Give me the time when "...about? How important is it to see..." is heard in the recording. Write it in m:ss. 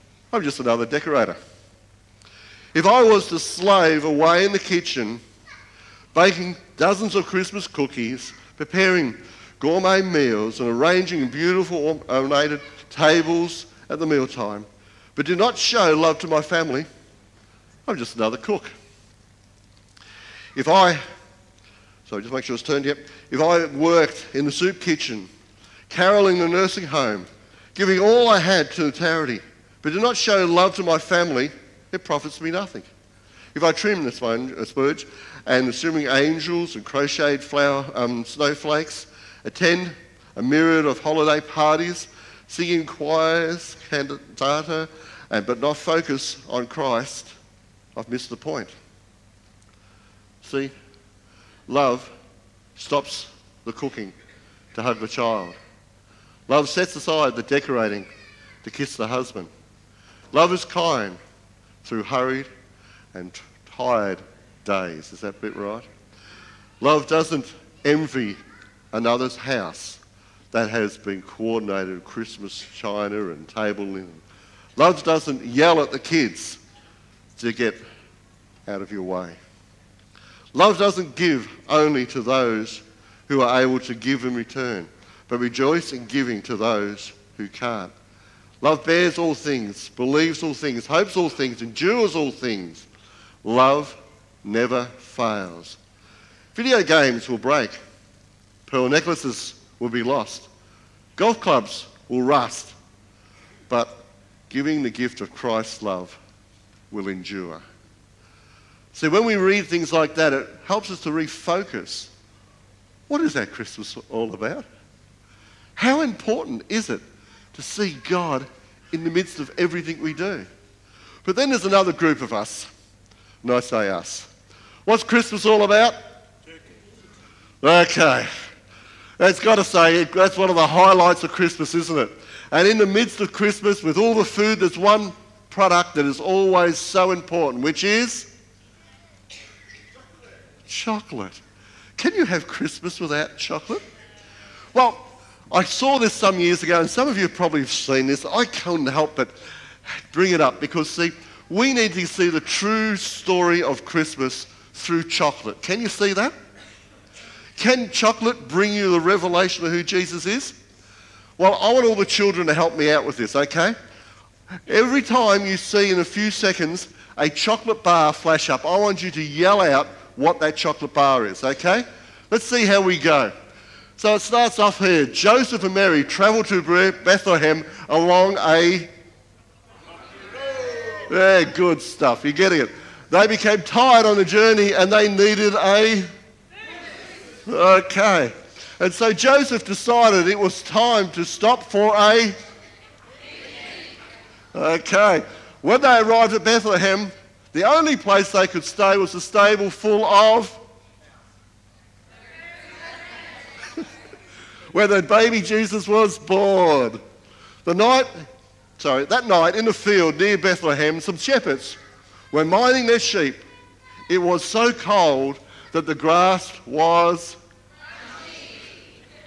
1:54.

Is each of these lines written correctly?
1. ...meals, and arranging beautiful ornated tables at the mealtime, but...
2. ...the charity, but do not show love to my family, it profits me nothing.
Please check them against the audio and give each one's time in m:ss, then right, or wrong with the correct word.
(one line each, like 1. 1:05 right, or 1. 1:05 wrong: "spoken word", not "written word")
1. 0:10 right
2. 0:28 right.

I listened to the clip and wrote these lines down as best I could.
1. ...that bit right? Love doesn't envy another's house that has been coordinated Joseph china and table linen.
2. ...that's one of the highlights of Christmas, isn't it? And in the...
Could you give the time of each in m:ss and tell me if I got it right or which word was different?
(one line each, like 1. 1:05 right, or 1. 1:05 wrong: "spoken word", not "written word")
1. 1:05 wrong: "Christmas", not "Joseph"
2. 2:10 right.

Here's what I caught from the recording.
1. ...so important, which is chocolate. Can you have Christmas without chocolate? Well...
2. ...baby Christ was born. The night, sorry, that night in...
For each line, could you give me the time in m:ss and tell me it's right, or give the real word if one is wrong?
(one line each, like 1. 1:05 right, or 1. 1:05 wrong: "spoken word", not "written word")
1. 2:16 right
2. 3:25 wrong: "Jesus", not "Christ".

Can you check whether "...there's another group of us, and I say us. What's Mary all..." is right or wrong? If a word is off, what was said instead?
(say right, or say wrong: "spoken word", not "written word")
wrong: "Christmas", not "Mary".